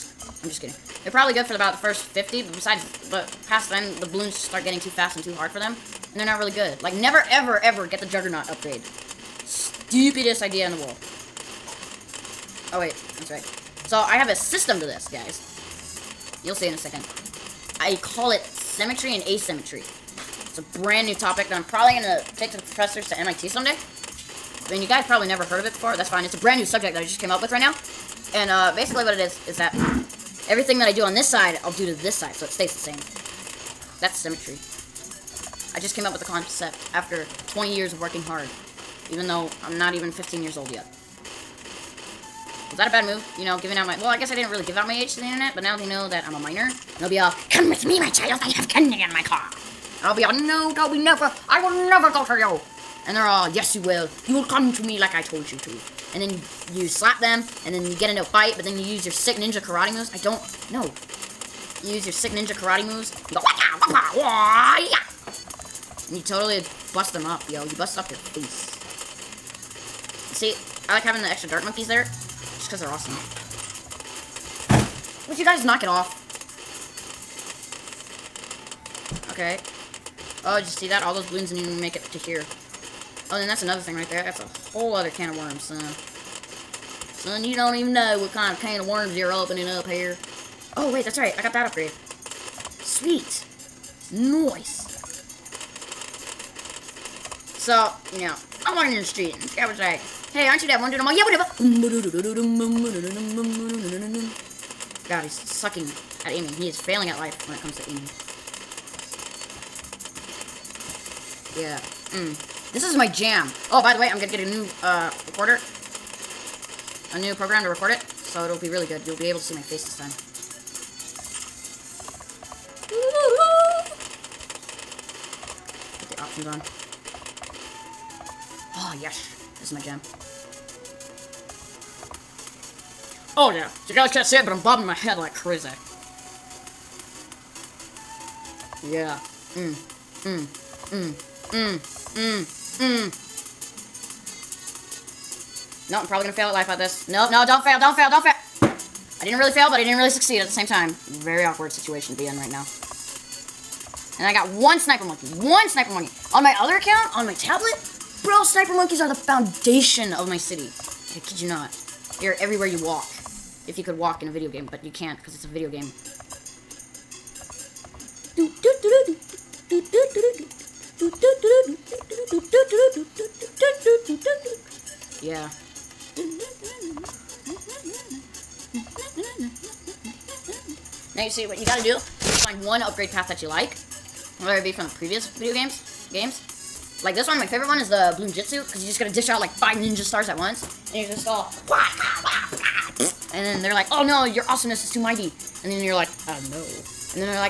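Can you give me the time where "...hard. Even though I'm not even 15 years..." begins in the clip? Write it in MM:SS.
00:38.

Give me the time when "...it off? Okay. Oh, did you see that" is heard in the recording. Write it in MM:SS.
01:15.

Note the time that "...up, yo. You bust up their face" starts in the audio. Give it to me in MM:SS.
01:07.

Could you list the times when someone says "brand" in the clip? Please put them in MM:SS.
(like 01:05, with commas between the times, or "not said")
00:20, 00:26.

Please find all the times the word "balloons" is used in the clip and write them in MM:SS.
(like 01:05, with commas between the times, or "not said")
00:04, 01:21.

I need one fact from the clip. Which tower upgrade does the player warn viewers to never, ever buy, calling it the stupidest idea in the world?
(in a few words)
Juggernaut.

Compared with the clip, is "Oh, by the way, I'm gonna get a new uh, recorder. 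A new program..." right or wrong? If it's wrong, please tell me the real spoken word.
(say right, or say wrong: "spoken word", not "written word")
right.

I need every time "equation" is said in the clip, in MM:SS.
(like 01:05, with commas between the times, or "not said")
not said.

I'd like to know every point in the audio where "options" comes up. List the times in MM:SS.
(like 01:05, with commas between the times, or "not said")
02:06.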